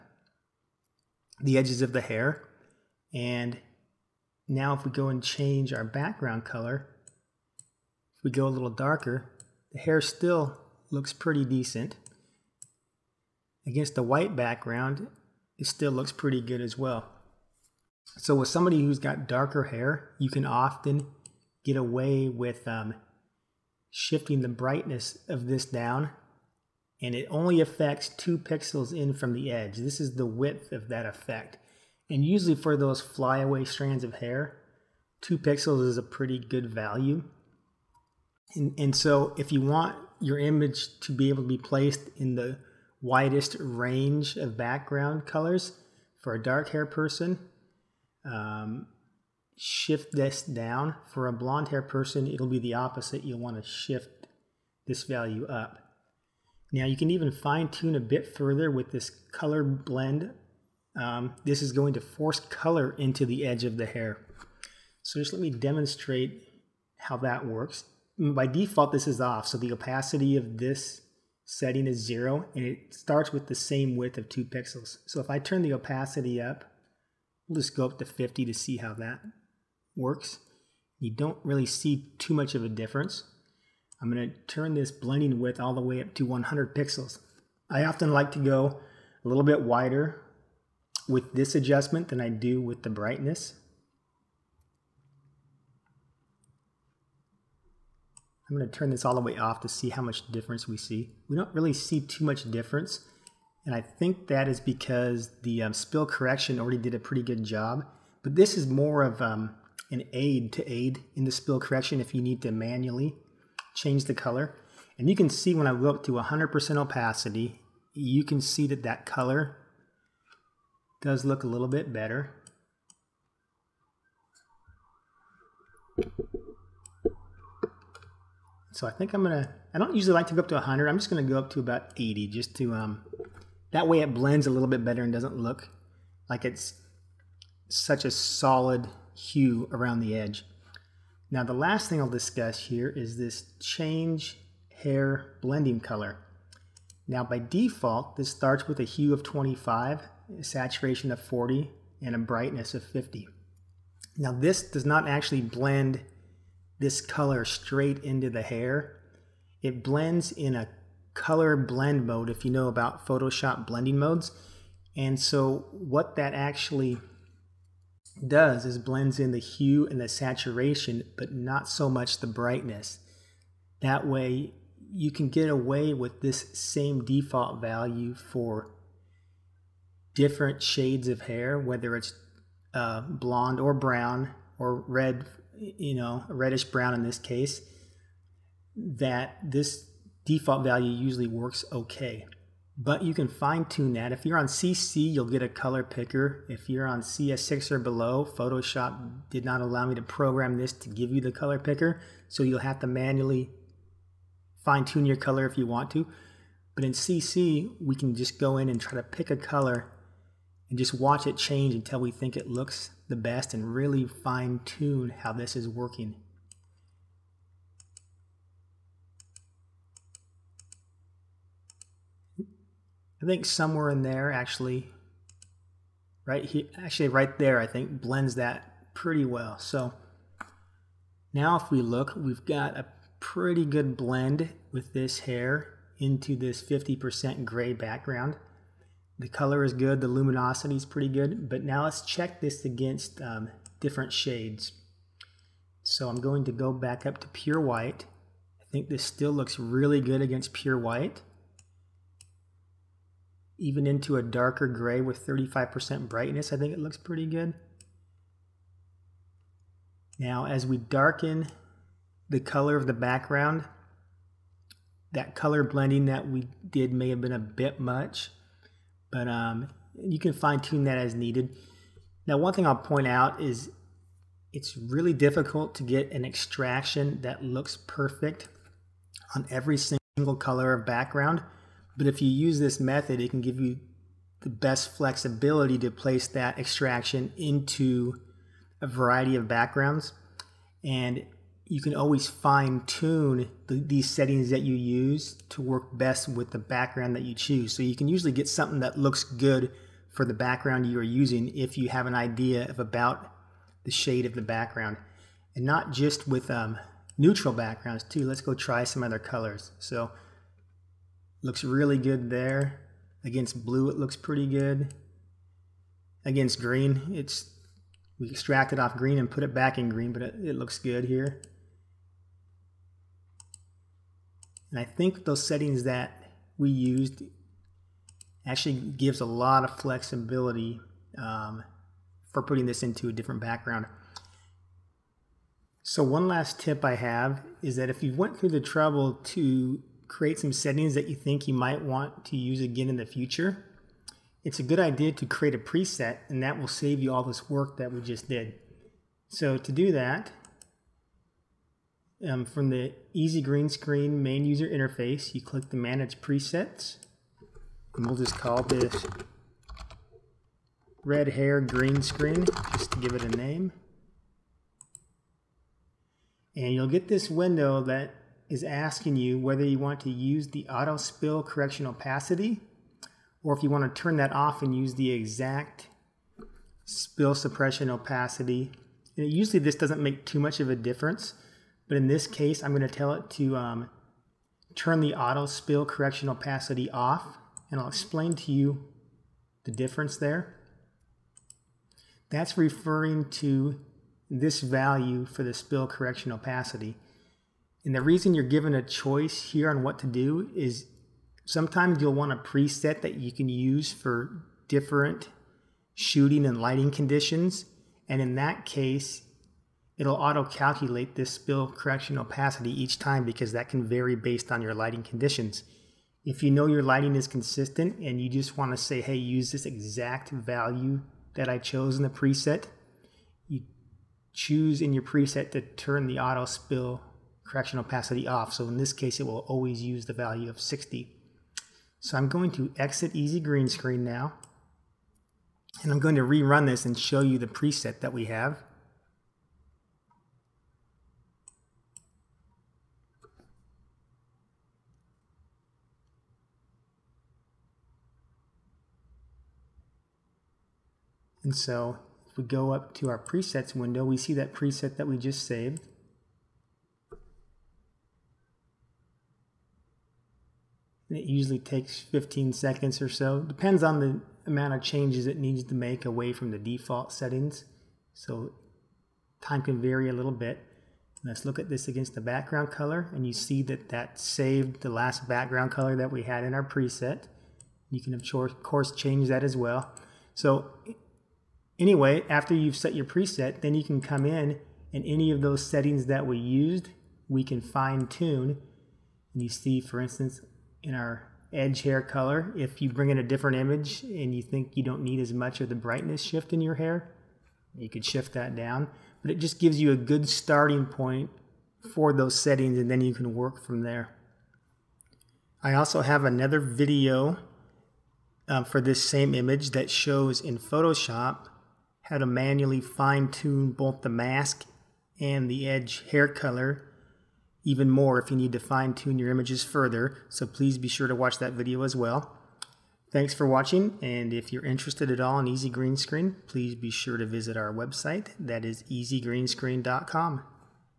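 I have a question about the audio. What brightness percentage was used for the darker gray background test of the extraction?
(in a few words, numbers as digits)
35%.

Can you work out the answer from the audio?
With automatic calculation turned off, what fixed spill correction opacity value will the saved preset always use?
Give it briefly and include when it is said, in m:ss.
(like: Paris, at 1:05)
60, at 7:10.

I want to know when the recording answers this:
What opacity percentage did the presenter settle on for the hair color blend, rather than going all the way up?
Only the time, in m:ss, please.
2:11.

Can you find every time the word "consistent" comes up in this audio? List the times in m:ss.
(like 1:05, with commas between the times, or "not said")
6:57.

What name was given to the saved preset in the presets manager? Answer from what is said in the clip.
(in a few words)
Red Hair Green Screen.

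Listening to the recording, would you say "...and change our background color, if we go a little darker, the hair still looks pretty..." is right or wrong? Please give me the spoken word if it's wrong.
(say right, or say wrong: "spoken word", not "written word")
right.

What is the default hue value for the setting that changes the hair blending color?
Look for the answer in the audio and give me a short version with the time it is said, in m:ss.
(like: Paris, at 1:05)
25, at 2:29.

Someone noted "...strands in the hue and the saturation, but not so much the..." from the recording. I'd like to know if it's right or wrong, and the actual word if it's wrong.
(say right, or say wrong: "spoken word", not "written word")
wrong: "blends", not "strands".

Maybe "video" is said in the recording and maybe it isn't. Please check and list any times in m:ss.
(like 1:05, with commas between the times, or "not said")
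8:26, 8:41.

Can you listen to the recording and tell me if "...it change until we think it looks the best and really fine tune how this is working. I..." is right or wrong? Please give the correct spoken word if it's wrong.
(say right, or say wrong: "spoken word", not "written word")
right.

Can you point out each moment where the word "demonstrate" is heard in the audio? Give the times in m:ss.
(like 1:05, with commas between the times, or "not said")
1:05.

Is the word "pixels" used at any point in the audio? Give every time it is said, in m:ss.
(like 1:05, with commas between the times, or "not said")
0:28, 0:35, 1:14, 1:26.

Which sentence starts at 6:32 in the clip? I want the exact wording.
That's referring to this value for the spill correction opacity.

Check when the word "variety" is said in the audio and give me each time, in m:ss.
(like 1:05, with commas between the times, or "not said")
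4:48.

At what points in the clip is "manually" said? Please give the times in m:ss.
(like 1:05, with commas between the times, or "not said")
1:52, 3:22, 8:32.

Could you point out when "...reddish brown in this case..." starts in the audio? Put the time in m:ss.
3:06.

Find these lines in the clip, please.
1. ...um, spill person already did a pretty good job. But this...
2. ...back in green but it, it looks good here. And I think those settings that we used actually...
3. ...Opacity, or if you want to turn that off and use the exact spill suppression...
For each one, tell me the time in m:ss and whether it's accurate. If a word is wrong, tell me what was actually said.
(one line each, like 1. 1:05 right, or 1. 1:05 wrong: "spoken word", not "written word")
1. 1:45 wrong: "correction", not "person"
2. 5:19 right
3. 6:11 right.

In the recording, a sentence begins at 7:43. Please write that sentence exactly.
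Depends on the amount of changes it needs to make away from the default settings.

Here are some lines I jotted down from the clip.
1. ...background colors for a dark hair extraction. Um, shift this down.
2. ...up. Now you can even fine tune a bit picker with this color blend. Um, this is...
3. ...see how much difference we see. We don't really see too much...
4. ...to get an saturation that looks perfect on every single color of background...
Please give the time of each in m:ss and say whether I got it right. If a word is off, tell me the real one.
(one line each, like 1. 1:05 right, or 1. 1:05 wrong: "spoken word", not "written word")
1. 0:44 wrong: "person", not "extraction"
2. 0:55 wrong: "further", not "picker"
3. 1:39 right
4. 4:35 wrong: "extraction", not "saturation".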